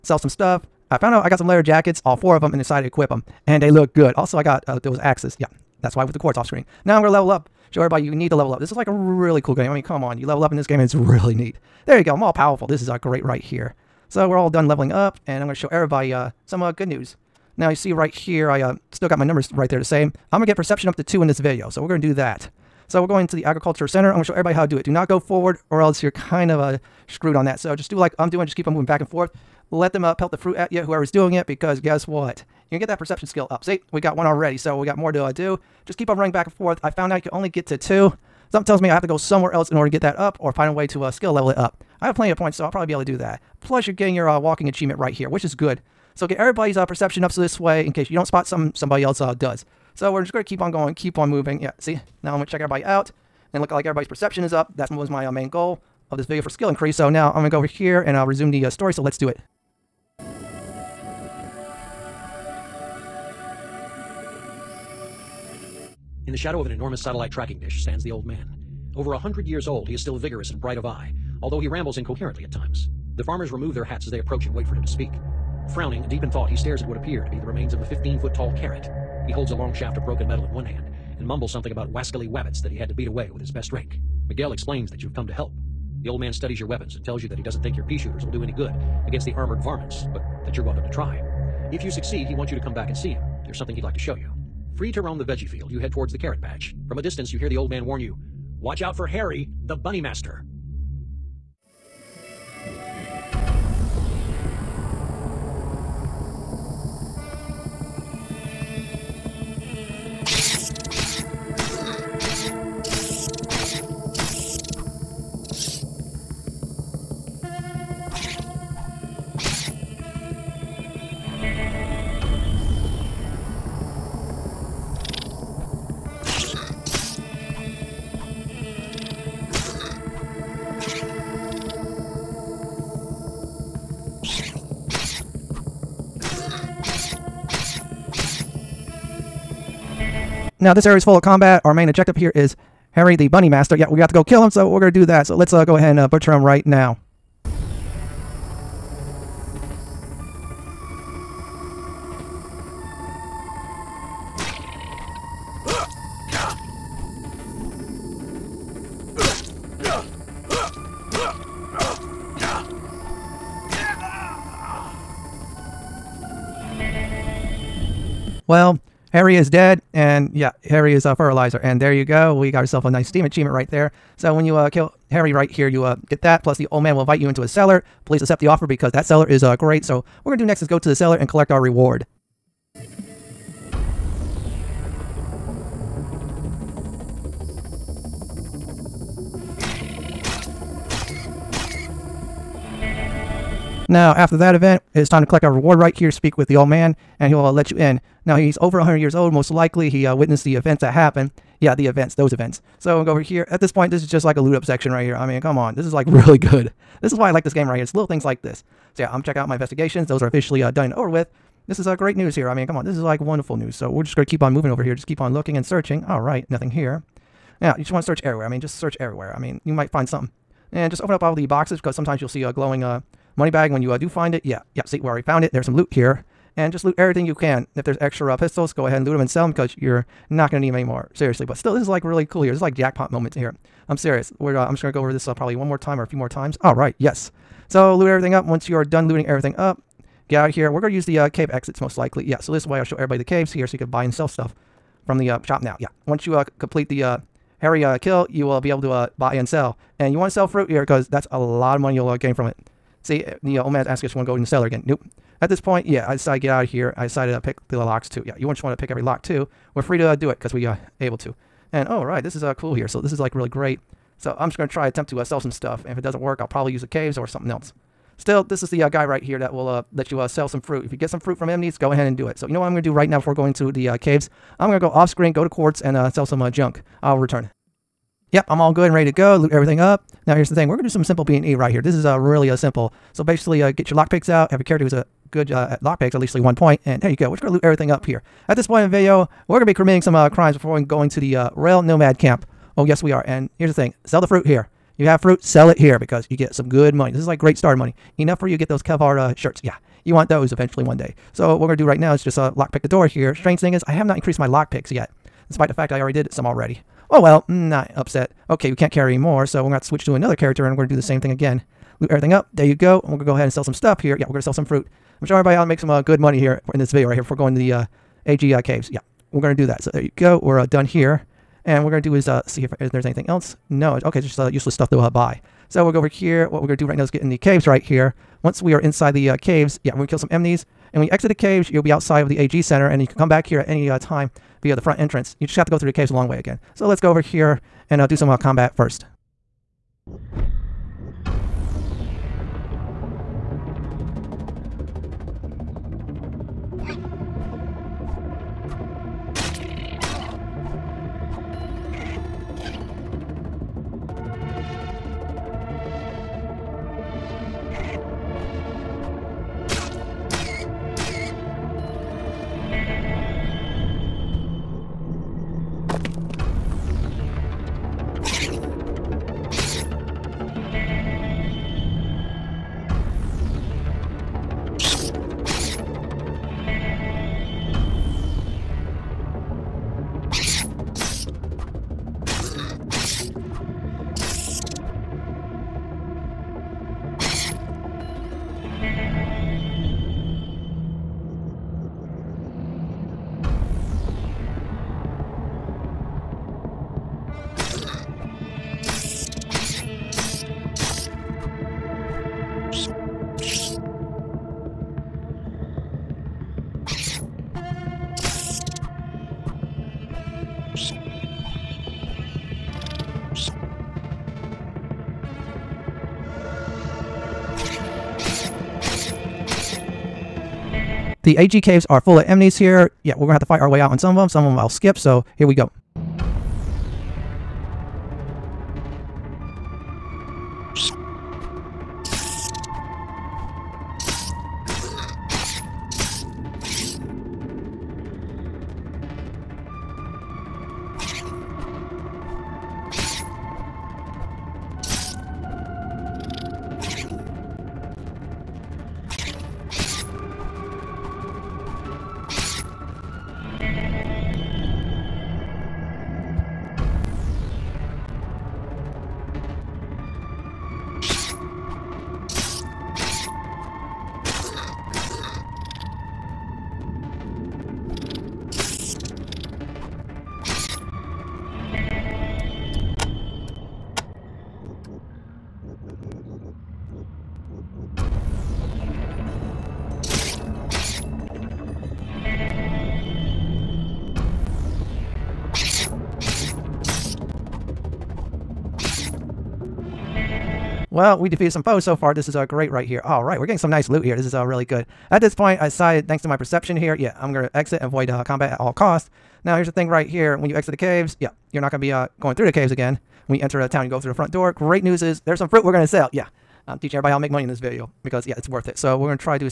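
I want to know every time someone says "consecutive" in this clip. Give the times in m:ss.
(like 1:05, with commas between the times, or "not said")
not said.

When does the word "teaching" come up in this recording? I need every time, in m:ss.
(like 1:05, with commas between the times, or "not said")
8:26.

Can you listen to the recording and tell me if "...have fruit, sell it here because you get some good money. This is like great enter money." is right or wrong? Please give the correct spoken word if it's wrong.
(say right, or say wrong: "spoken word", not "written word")
wrong: "starter", not "enter".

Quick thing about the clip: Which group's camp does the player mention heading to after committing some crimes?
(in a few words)
Rail Nomad.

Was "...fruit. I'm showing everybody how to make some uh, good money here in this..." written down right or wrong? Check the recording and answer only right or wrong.
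right.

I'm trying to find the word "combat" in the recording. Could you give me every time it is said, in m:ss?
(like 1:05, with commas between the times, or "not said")
2:21, 5:38, 8:18.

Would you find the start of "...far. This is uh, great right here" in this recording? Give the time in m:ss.
8:11.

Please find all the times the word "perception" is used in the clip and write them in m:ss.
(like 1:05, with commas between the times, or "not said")
0:20, 0:32, 0:46, 0:54, 8:16.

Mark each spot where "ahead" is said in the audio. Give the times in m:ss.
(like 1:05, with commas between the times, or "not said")
2:25, 3:48, 4:31, 5:13.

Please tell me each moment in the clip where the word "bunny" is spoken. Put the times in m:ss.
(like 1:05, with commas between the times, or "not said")
1:39, 2:23.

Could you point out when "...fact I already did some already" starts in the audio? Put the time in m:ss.
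5:05.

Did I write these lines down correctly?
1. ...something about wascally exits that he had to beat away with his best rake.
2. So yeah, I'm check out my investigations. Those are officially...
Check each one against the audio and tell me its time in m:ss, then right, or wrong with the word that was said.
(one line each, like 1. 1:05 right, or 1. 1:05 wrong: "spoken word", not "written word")
1. 1:21 wrong: "wabbits", not "exits"
2. 3:28 right.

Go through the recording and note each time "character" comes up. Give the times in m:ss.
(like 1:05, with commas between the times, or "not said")
4:44, 5:10.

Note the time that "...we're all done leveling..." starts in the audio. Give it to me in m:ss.
0:14.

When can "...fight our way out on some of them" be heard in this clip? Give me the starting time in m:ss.
7:03.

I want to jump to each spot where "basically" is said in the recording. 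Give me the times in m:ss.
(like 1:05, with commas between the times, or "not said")
4:43.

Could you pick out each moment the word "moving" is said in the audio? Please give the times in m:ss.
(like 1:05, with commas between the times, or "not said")
0:28, 0:51, 3:34.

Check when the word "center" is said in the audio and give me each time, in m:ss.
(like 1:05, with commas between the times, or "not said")
0:23, 5:32.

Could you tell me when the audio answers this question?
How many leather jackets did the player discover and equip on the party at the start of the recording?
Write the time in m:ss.
0:02.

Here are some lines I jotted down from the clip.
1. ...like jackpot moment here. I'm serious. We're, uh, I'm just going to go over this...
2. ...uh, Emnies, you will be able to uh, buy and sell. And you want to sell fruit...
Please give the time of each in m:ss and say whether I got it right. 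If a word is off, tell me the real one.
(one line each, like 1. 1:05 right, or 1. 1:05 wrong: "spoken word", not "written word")
1. 3:52 right
2. 4:07 wrong: "Kill", not "Emnies".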